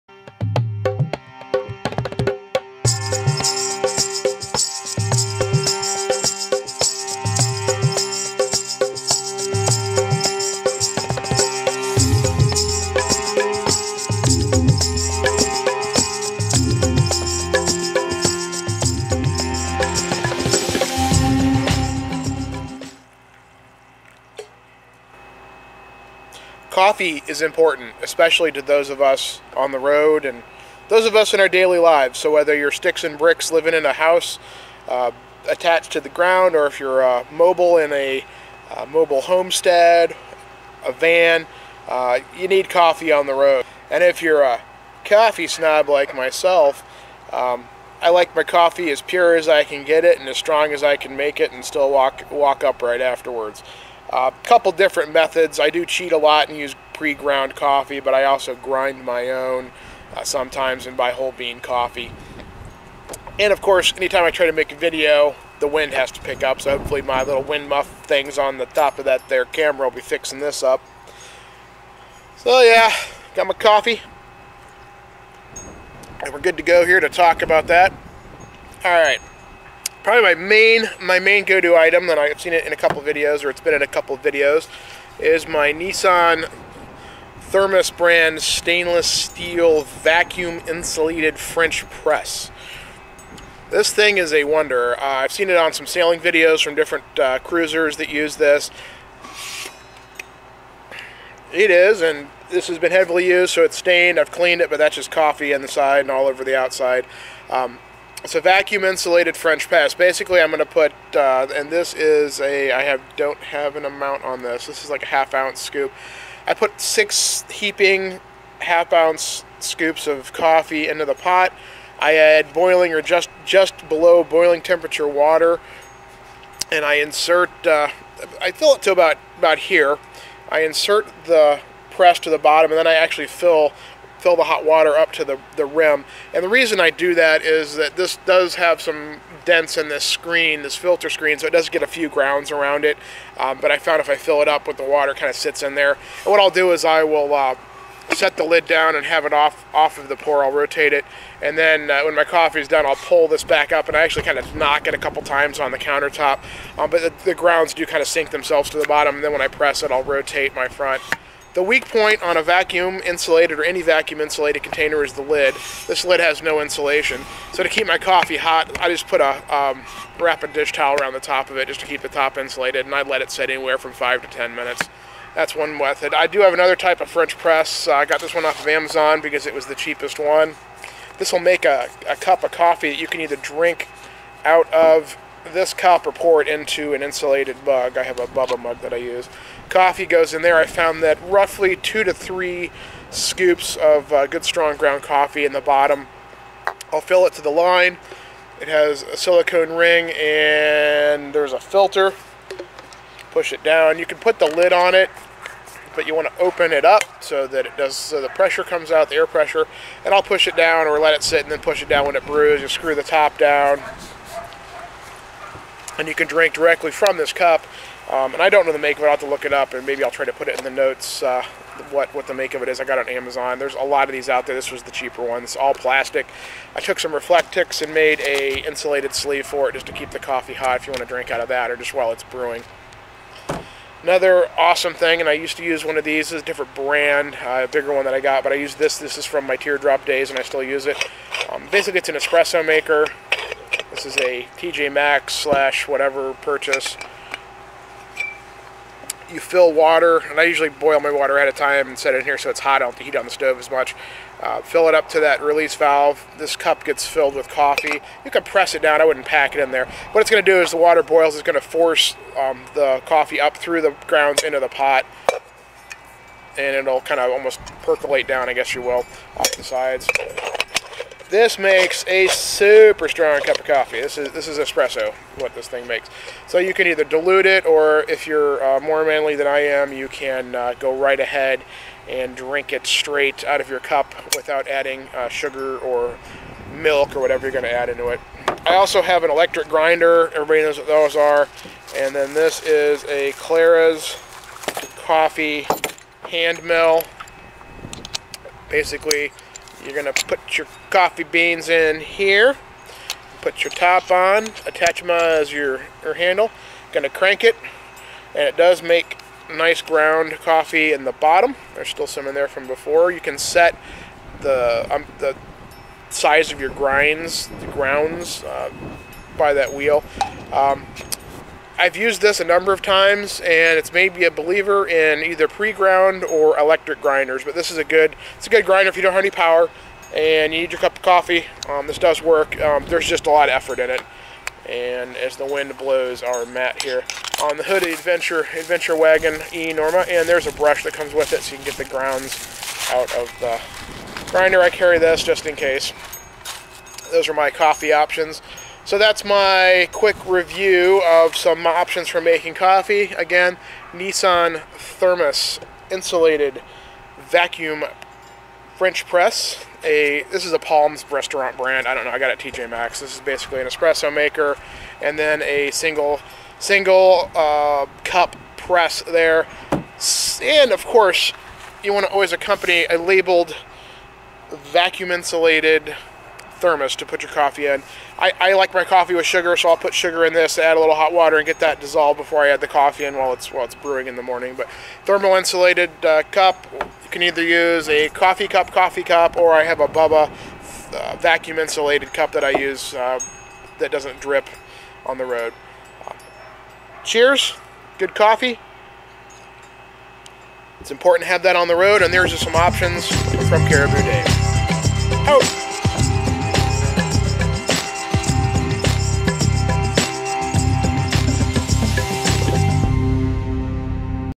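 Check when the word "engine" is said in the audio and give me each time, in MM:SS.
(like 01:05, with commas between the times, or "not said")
not said.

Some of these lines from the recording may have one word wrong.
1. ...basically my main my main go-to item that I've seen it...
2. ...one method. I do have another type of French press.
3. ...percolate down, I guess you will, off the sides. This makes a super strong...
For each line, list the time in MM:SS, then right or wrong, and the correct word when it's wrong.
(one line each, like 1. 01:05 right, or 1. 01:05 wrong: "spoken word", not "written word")
1. 01:20 wrong: "probably", not "basically"
2. 02:55 right
3. 04:27 right.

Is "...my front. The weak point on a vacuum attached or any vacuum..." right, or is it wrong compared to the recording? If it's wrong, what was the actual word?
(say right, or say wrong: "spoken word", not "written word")
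wrong: "insulated", not "attached".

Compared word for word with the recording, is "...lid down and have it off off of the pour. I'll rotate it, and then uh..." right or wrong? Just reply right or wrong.
right.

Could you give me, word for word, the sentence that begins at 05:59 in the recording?
A this is a Palms restaurant brand.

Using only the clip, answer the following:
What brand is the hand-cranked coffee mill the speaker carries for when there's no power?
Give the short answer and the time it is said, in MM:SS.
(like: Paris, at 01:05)
Clara's, at 04:53.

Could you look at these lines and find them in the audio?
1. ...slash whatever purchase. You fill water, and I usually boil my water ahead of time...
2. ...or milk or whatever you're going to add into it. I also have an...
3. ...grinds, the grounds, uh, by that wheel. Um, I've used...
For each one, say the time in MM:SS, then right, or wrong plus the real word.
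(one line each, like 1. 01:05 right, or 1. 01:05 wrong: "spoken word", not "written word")
1. 04:05 right
2. 04:45 right
3. 05:16 right.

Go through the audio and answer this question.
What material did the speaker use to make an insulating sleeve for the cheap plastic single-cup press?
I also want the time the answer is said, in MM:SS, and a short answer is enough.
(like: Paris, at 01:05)
Reflectix, at 03:47.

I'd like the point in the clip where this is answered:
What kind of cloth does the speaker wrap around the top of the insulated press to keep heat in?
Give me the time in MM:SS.
02:50.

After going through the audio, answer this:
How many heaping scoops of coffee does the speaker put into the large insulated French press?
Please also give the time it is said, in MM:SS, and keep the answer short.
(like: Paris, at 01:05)
6, at 01:56.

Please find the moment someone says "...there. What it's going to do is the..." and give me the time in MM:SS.
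04:19.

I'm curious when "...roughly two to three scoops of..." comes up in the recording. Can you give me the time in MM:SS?
03:11.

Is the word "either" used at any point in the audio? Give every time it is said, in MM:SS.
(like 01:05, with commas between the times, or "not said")
03:03, 04:36, 05:25, 06:27.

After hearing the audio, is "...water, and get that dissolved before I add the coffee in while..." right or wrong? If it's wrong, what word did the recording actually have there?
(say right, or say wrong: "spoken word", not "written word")
right.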